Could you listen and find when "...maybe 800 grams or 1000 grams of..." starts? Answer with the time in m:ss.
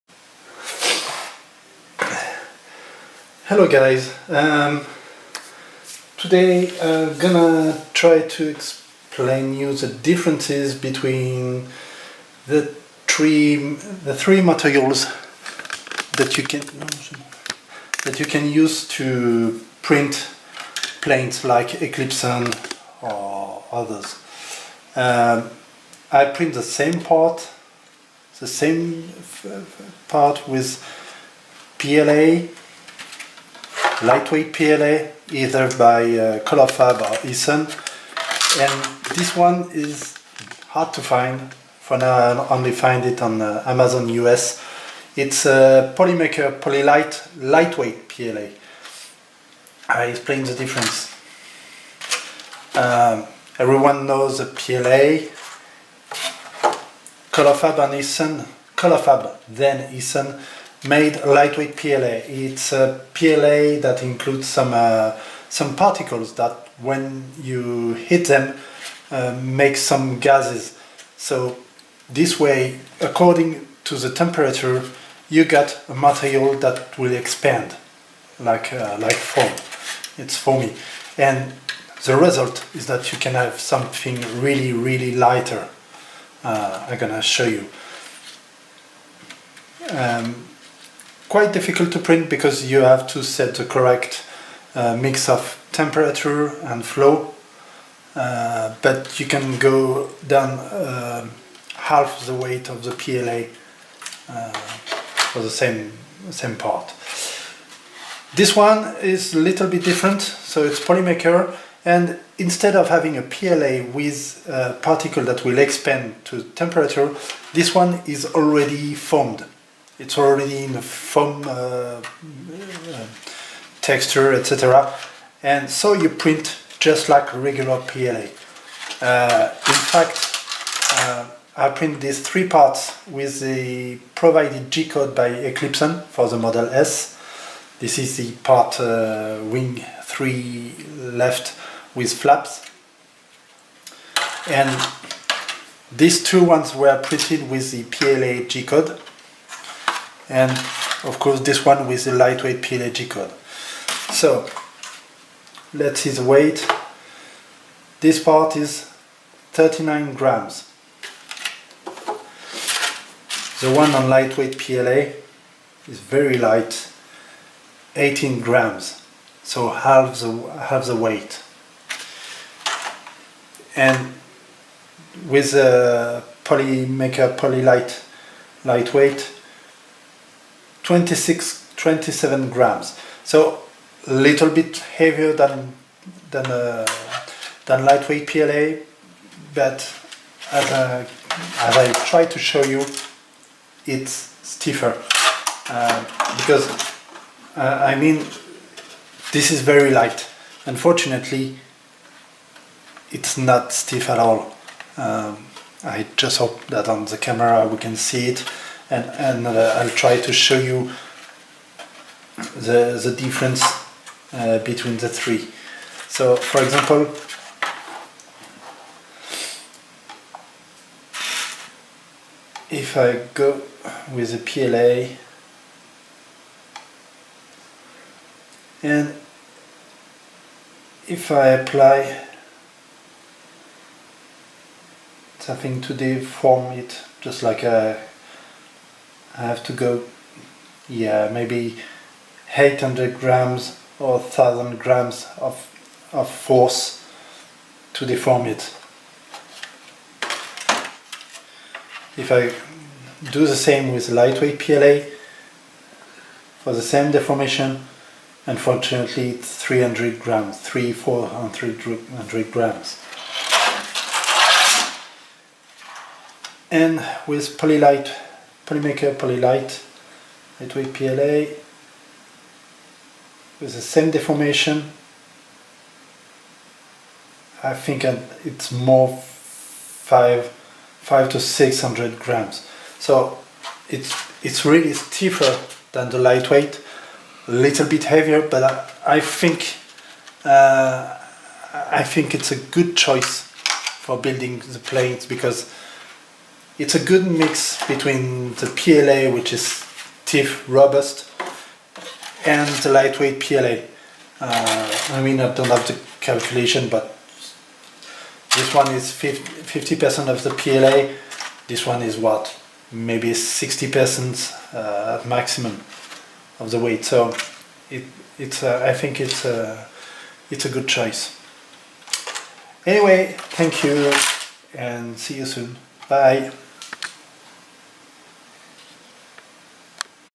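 4:01.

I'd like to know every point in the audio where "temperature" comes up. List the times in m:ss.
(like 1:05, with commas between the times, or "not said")
1:14, 1:35, 1:56.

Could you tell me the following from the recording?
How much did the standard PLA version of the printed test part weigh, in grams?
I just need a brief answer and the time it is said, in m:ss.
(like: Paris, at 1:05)
39 grams, at 2:39.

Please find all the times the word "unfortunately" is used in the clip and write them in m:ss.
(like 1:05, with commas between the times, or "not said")
3:20, 4:18.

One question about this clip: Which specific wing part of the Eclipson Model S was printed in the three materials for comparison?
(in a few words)
Wing 3 left with flaps.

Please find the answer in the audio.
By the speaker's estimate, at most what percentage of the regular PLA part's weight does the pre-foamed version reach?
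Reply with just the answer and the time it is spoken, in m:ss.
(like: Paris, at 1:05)
60%, at 5:13.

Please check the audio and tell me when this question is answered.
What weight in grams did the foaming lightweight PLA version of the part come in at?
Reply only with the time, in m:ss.
2:47.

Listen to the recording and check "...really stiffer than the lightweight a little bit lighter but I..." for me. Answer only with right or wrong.
wrong.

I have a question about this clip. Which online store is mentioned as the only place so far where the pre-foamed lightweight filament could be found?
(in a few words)
Amazon US.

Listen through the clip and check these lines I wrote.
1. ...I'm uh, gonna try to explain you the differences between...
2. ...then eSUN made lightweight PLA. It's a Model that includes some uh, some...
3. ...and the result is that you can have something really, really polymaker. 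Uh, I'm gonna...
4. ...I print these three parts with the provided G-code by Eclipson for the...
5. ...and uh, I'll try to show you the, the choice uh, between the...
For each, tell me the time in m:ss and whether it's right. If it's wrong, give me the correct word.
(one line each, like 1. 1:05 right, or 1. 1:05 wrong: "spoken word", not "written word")
1. 0:06 right
2. 0:59 wrong: "PLA", not "Model"
3. 1:21 wrong: "lighter", not "polymaker"
4. 2:11 right
5. 3:29 wrong: "difference", not "choice".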